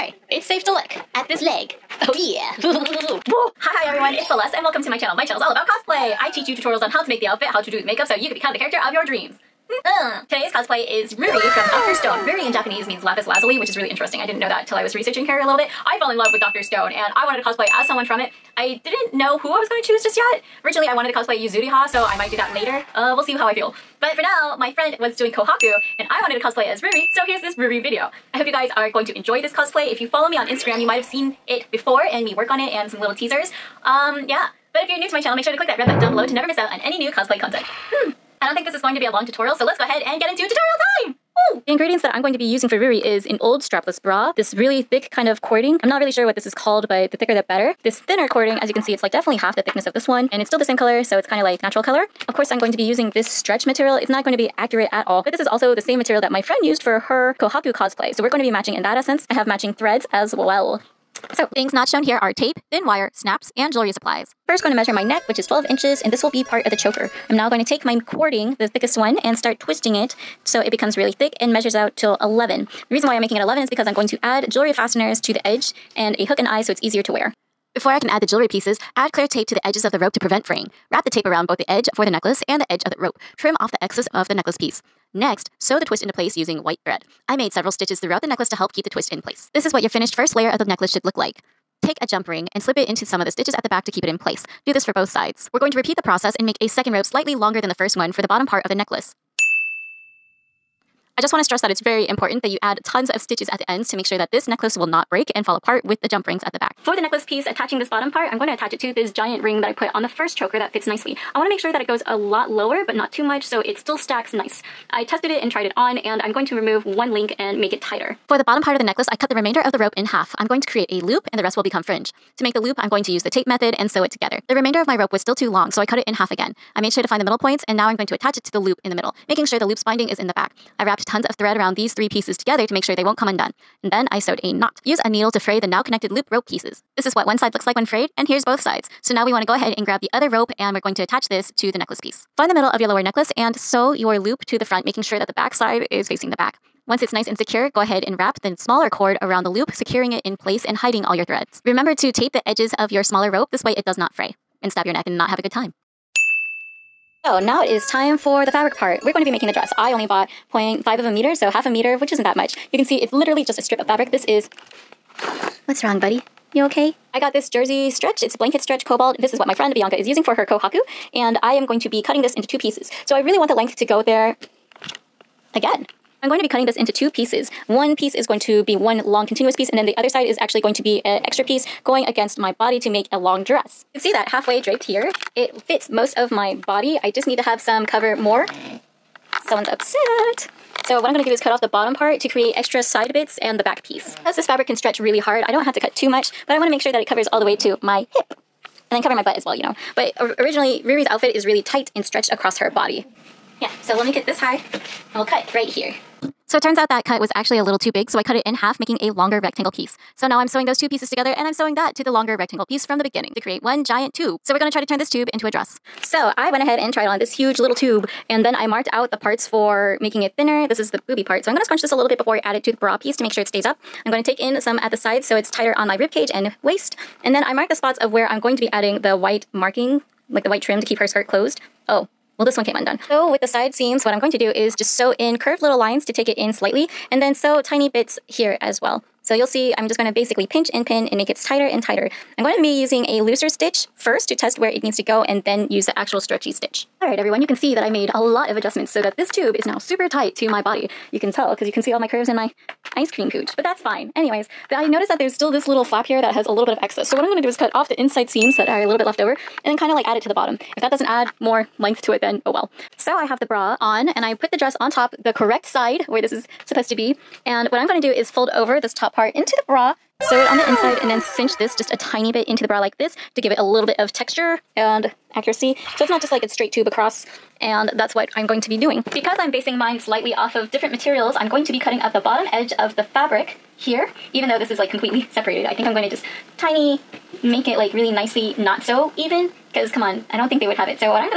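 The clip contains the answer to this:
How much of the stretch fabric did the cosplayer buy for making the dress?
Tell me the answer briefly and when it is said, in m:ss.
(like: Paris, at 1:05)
Half a meter, at 2:41.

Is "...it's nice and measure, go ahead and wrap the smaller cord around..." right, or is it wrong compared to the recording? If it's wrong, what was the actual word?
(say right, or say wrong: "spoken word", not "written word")
wrong: "secure", not "measure".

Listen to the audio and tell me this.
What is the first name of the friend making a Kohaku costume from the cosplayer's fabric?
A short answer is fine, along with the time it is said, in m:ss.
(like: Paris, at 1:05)
Bianca, at 2:49.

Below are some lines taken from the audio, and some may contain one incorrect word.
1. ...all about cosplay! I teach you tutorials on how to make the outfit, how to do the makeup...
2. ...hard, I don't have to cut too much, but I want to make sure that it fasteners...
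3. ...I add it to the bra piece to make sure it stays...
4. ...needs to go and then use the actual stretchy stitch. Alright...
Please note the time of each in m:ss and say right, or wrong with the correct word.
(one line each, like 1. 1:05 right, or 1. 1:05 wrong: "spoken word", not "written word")
1. 0:05 right
2. 3:15 wrong: "covers", not "fasteners"
3. 3:42 right
4. 4:04 right.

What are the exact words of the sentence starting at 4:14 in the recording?
Anyways, I noticed that there's still this little flap here that has a little bit of excess.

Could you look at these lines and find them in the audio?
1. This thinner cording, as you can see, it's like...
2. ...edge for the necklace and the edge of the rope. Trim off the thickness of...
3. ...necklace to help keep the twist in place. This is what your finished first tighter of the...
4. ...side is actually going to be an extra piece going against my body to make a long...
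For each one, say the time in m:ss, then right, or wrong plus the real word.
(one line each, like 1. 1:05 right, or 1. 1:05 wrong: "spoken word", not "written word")
1. 0:47 right
2. 1:21 wrong: "excess", not "thickness"
3. 1:28 wrong: "layer", not "tighter"
4. 3:00 right.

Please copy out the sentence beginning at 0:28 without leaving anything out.
I hope you guys are going to enjoy this cosplay.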